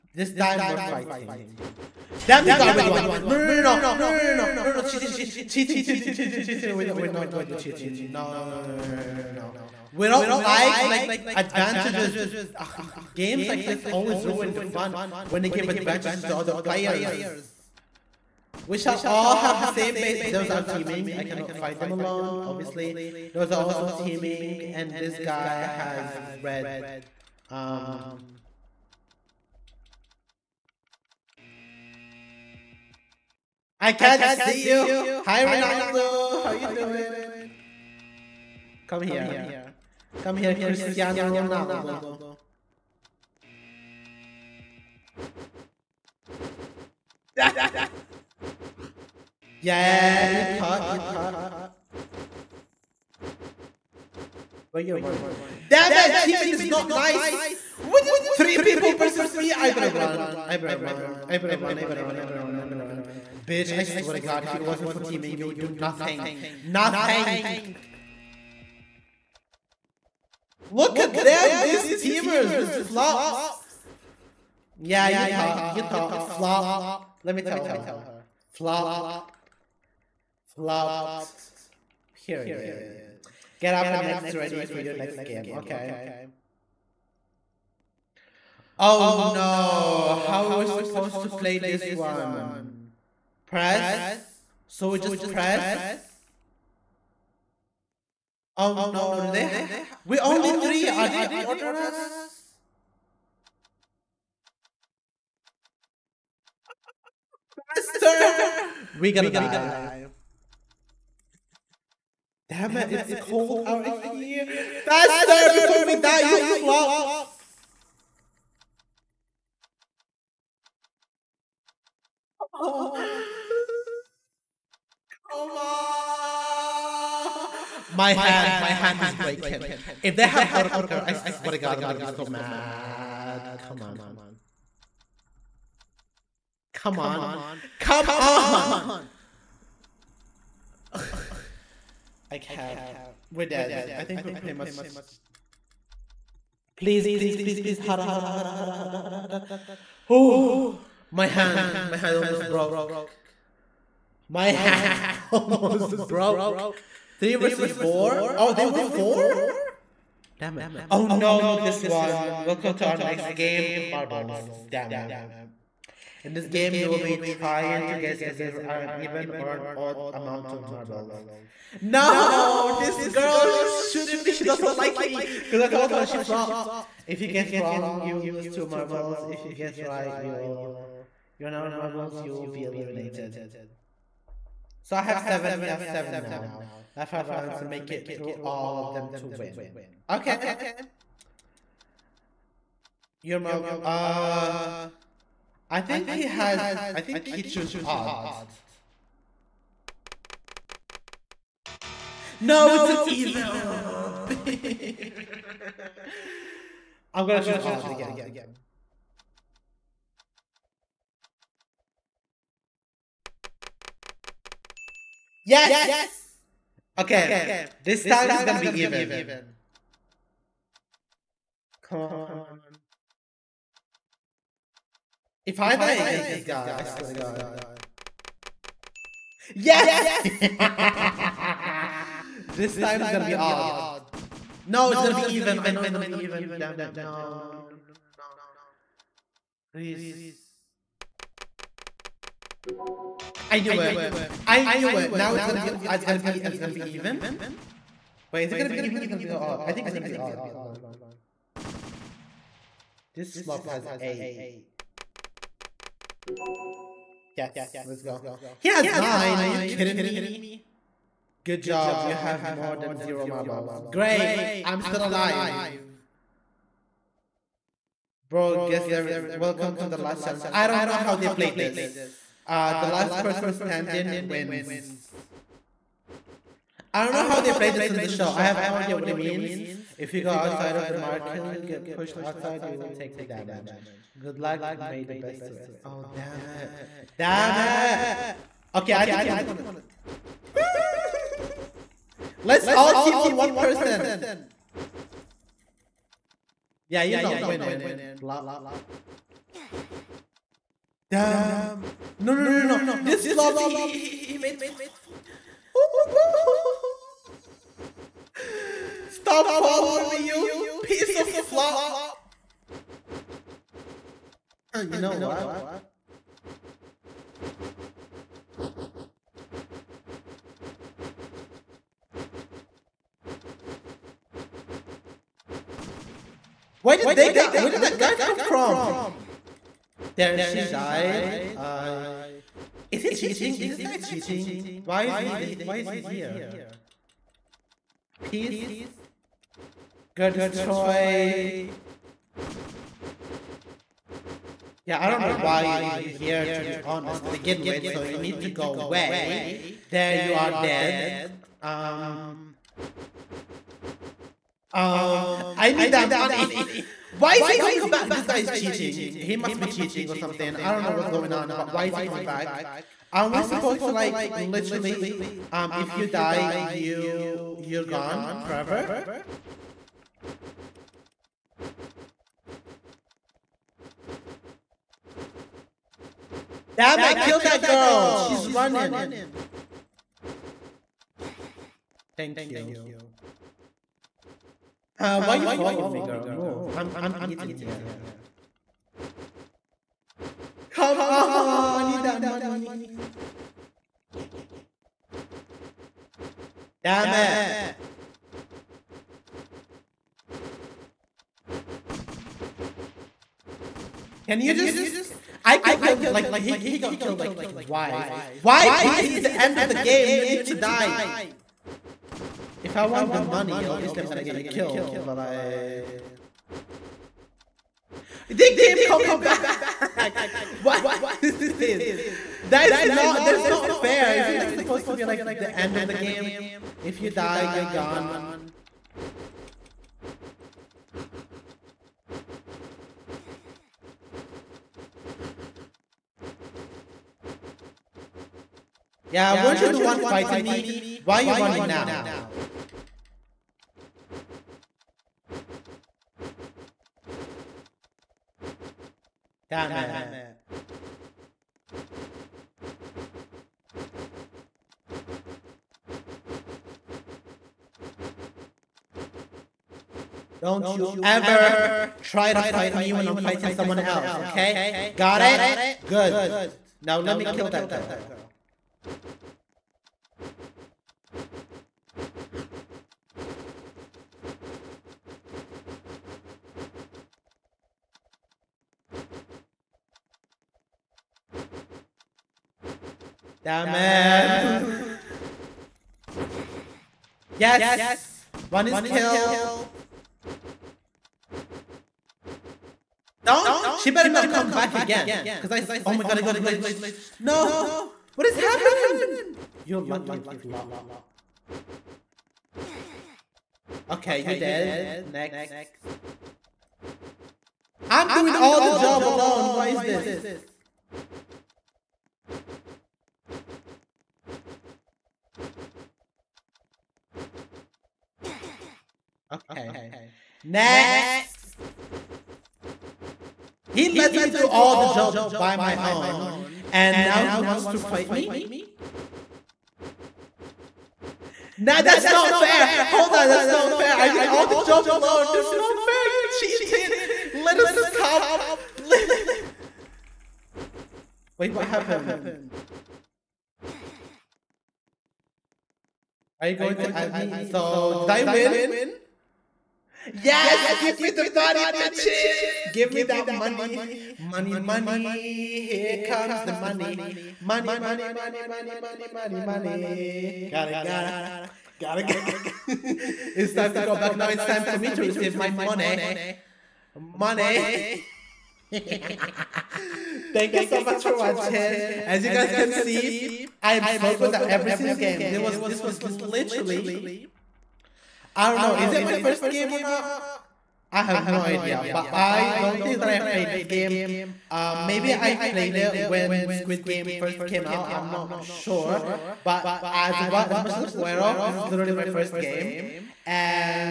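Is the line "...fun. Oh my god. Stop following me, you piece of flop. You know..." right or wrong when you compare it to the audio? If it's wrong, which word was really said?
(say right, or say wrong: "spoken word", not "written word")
right.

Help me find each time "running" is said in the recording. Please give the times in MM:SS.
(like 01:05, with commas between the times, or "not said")
00:54, 06:18, 07:21.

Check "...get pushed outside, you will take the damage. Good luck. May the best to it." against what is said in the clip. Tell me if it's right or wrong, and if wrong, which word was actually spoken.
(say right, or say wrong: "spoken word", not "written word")
right.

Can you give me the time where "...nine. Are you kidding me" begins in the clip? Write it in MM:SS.
04:18.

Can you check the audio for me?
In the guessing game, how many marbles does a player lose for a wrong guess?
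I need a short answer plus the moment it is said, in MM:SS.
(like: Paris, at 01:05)
2, at 02:58.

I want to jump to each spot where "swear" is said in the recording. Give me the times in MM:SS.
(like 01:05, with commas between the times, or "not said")
01:03, 02:11, 03:46.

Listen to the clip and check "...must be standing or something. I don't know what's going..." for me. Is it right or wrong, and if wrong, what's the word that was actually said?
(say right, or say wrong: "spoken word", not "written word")
wrong: "cheating", not "standing".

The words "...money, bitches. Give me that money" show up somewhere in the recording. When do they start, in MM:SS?
09:11.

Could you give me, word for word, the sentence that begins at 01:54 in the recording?
Faster before we die, you flops.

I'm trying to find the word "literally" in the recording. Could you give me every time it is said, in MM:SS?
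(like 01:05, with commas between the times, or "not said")
06:04, 09:36, 09:51.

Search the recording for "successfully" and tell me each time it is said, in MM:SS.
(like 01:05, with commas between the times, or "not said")
not said.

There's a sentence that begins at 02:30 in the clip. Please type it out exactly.
Oh, my hand, my hand almost broke.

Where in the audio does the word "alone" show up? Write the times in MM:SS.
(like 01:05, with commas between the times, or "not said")
00:21, 08:29, 08:54.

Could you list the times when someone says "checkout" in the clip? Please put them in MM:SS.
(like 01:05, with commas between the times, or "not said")
not said.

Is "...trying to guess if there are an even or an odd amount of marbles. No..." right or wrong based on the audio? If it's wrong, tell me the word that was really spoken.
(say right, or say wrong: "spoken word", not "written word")
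right.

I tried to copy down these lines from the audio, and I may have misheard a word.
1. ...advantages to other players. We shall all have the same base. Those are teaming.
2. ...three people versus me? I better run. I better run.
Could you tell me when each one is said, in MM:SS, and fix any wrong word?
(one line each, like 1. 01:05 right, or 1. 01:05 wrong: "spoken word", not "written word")
1. 00:15 right
2. 00:58 right.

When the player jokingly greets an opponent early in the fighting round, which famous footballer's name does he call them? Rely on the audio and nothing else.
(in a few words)
Cristiano Ronaldo.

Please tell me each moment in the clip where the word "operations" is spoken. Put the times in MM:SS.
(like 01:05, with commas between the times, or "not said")
not said.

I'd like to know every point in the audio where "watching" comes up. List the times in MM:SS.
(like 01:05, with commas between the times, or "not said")
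09:31.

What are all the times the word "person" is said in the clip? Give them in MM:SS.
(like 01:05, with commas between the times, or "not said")
04:33, 04:53.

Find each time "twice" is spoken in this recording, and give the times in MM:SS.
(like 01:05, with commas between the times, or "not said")
06:47.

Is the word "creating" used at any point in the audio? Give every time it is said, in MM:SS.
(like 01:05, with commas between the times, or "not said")
not said.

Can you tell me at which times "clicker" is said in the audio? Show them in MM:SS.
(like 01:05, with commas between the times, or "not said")
02:10.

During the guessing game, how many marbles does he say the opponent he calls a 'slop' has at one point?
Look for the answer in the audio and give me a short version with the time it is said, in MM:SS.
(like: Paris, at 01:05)
8, at 04:13.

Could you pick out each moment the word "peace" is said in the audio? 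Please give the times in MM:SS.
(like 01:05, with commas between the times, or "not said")
05:38, 06:48.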